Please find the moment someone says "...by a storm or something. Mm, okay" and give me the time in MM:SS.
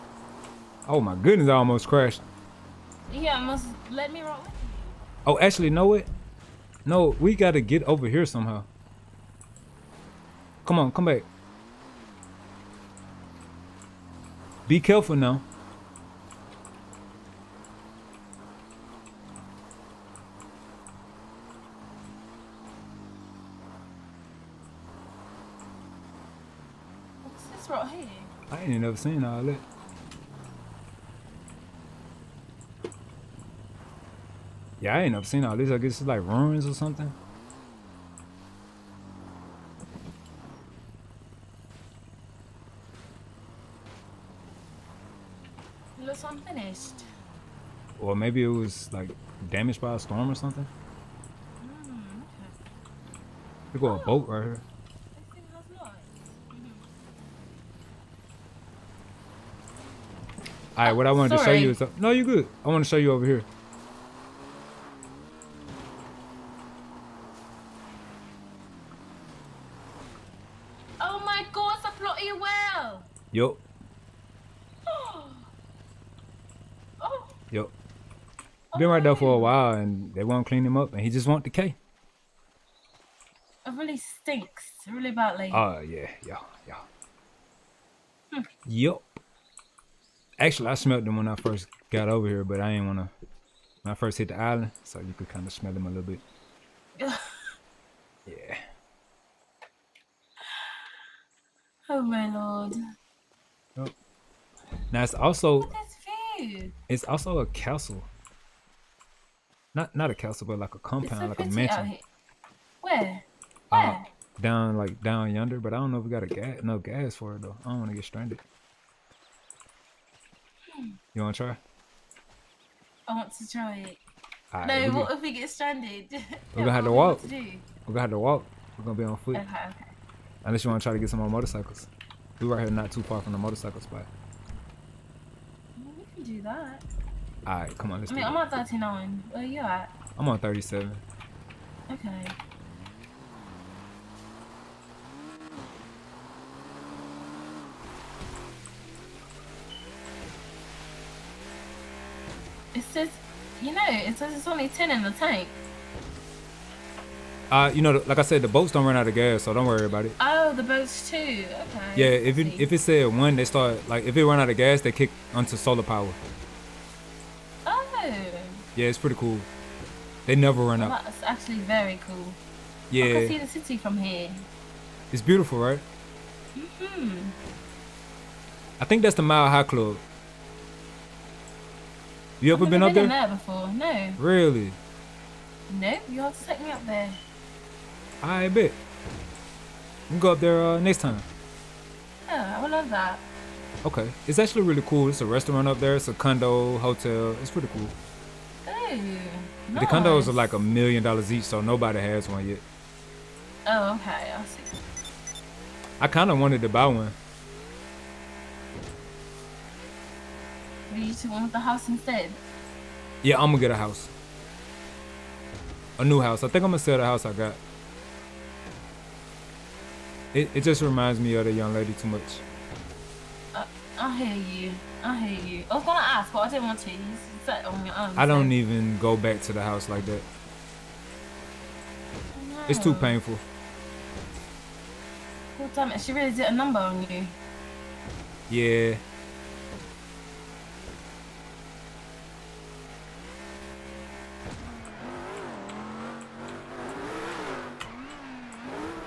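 00:49.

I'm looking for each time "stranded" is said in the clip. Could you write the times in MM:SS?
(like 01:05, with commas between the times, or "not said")
01:58, 02:05.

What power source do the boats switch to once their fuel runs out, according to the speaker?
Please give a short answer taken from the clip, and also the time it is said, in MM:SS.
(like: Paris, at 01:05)
Solar power, at 02:45.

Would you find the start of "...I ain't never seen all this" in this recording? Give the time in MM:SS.
00:34.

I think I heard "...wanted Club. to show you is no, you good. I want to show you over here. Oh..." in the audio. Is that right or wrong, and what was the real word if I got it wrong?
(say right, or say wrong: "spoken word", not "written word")
wrong: "Sorry", not "Club".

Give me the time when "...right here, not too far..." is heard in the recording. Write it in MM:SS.
02:12.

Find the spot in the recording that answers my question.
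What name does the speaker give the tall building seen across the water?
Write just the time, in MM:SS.
02:59.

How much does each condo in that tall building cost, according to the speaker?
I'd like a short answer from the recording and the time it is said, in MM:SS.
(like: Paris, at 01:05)
A million dollars, at 03:20.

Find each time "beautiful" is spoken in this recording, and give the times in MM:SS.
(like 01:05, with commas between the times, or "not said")
02:55.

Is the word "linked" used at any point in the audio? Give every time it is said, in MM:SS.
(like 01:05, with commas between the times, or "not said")
not said.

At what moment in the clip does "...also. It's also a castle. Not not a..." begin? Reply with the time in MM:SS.
01:45.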